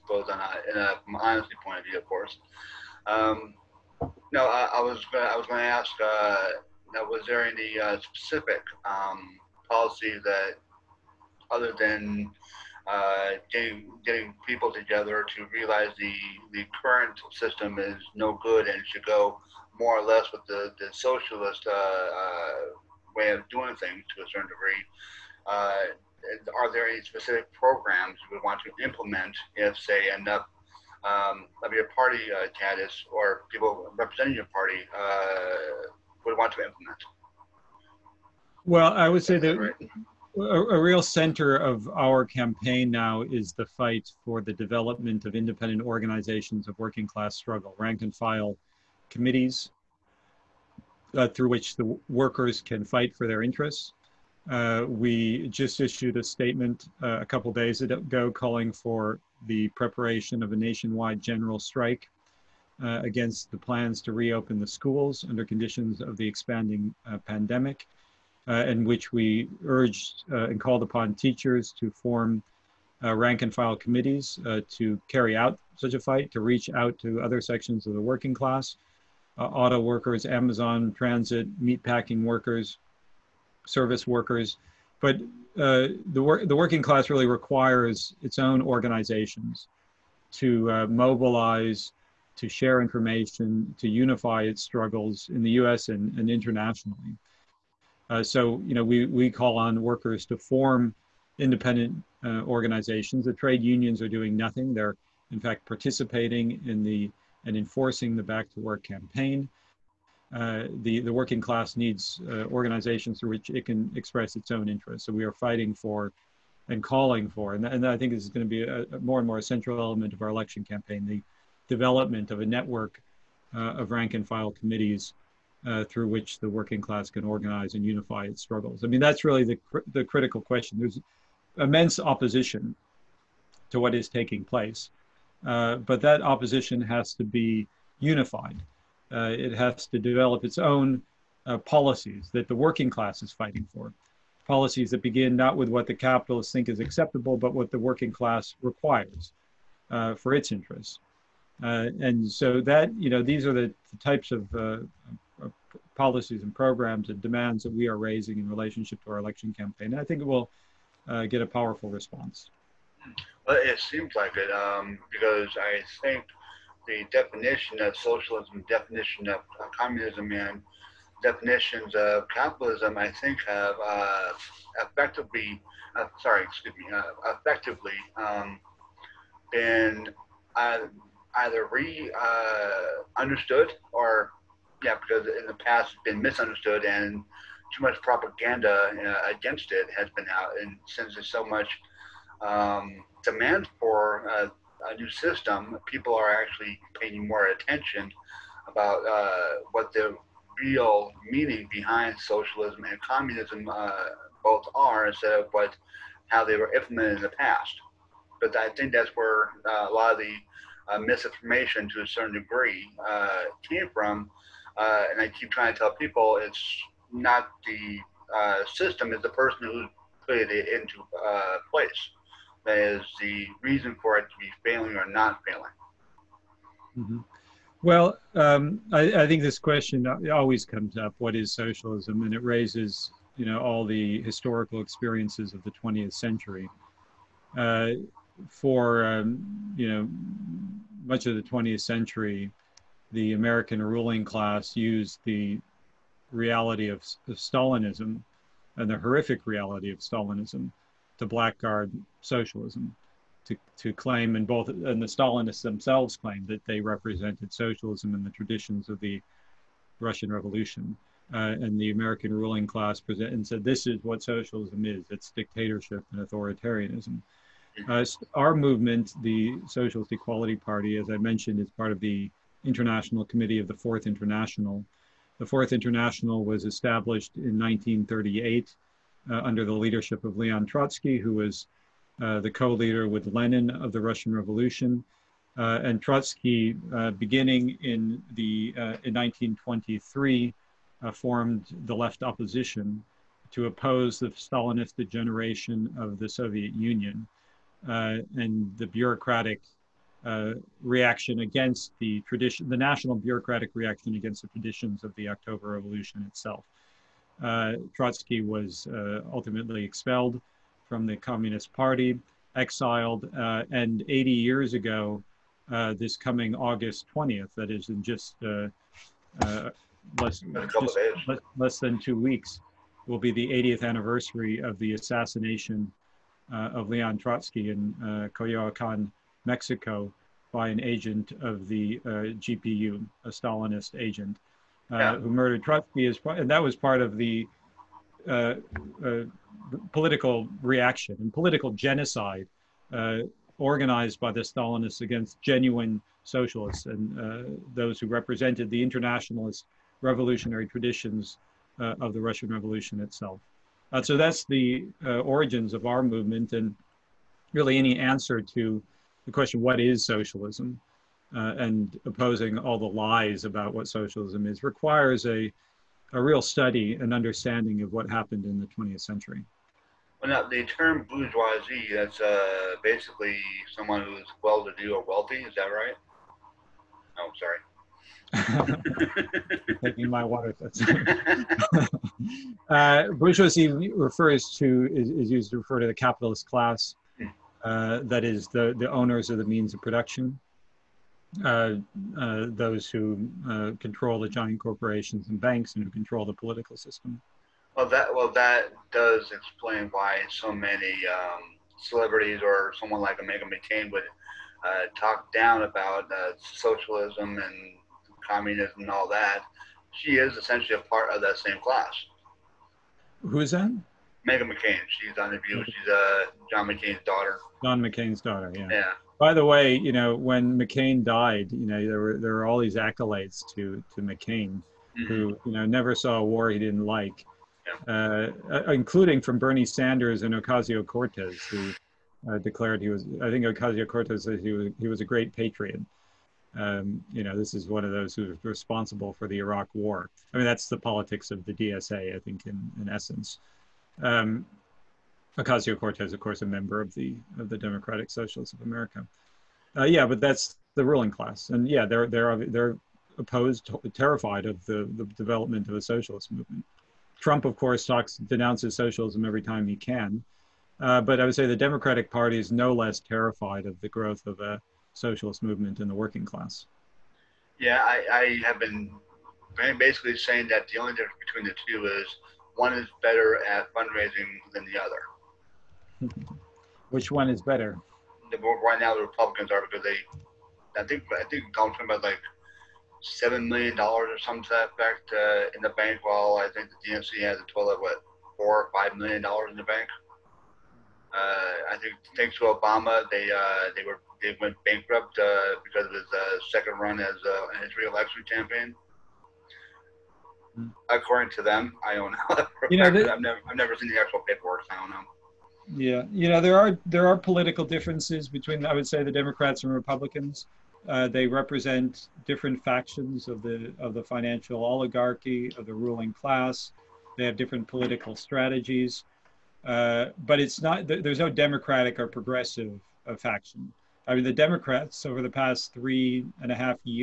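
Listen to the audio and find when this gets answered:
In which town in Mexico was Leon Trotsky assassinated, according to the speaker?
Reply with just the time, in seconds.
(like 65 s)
328 s.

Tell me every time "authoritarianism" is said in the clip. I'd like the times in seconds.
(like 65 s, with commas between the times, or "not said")
266 s.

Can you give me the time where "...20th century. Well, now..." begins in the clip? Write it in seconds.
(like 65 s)
368 s.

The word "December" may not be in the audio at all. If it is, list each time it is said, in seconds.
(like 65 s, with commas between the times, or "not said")
not said.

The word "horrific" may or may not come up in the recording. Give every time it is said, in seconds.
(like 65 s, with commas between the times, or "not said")
249 s.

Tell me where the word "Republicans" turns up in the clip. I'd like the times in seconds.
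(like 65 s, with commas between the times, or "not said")
479 s, 509 s.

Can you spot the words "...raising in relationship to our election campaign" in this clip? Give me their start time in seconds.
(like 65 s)
157 s.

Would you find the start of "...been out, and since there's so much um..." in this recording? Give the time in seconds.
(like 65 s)
190 s.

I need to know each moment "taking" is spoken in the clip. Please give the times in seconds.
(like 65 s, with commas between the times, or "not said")
134 s, 379 s.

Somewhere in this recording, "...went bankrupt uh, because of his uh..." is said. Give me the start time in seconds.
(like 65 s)
494 s.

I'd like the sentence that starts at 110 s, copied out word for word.
Uh, the, the working class needs uh, organizations through which it can express its own interests.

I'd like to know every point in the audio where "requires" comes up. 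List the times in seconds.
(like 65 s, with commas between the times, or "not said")
87 s, 148 s, 364 s.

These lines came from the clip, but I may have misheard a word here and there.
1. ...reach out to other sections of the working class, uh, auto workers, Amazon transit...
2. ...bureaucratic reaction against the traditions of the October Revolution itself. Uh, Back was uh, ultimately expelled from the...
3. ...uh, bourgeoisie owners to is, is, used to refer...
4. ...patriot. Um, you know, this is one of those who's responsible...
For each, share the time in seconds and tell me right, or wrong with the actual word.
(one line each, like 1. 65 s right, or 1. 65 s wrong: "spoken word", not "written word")
1. 76 s right
2. 303 s wrong: "Trotsky", not "Back"
3. 382 s wrong: "refers", not "owners"
4. 435 s right.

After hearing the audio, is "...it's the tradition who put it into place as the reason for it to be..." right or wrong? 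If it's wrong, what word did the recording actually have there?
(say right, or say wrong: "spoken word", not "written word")
wrong: "person", not "tradition".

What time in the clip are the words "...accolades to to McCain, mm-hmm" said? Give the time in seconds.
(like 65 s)
422 s.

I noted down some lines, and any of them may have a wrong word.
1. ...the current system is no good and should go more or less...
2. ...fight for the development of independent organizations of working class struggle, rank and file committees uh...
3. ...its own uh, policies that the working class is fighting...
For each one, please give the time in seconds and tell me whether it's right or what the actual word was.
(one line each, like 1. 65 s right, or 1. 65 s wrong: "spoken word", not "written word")
1. 16 s right
2. 43 s right
3. 140 s right.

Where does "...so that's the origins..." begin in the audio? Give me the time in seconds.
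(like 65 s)
354 s.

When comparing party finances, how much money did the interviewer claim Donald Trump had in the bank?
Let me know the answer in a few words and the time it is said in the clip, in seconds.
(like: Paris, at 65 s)
$7 million, at 483 s.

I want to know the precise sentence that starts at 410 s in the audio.
She is essentially a part of that same class.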